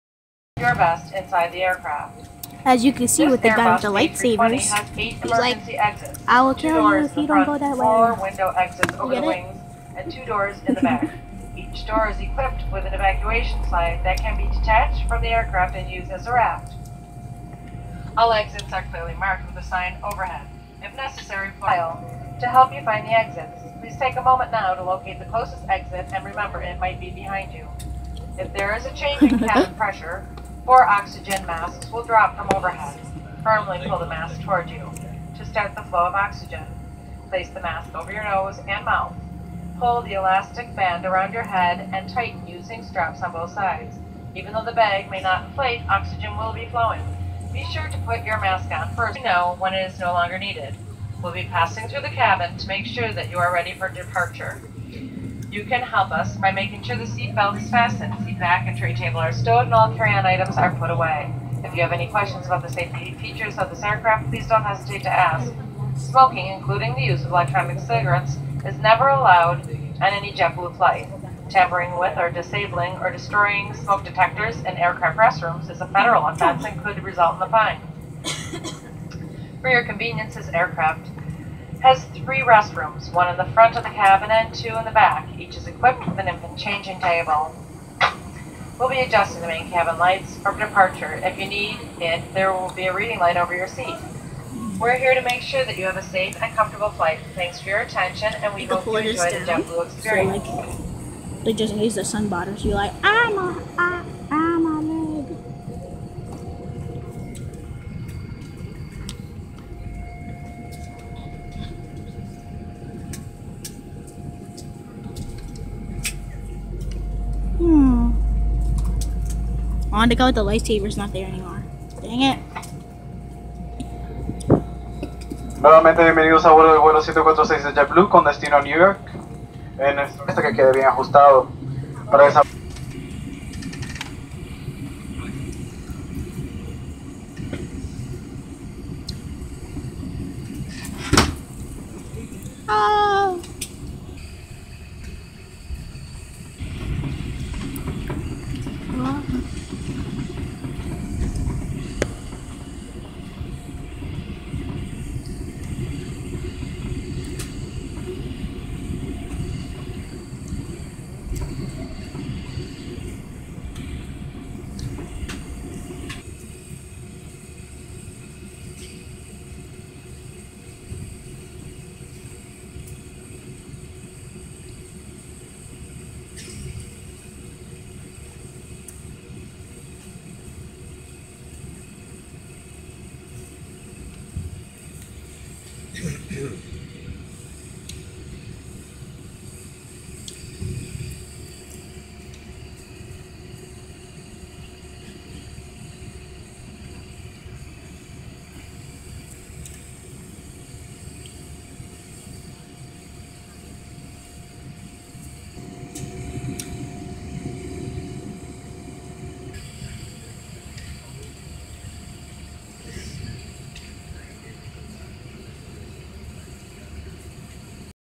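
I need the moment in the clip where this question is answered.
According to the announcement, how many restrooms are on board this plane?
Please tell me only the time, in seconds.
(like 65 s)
82 s.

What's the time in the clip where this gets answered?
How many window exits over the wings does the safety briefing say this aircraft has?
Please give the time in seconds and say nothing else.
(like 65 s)
7 s.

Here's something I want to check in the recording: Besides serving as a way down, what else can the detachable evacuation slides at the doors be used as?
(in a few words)
a raft.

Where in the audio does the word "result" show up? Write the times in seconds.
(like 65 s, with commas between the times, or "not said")
77 s.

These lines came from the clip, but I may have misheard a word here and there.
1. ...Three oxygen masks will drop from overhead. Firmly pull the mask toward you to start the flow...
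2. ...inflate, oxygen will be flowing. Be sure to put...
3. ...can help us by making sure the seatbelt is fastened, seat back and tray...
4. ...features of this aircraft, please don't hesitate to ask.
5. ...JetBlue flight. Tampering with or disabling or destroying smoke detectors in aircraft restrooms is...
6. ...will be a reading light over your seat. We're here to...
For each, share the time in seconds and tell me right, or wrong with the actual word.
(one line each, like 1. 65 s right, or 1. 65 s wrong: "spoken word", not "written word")
1. 30 s wrong: "Four", not "Three"
2. 45 s right
3. 55 s right
4. 63 s right
5. 70 s right
6. 92 s right.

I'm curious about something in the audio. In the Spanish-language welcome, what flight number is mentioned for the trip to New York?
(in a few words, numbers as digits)
146.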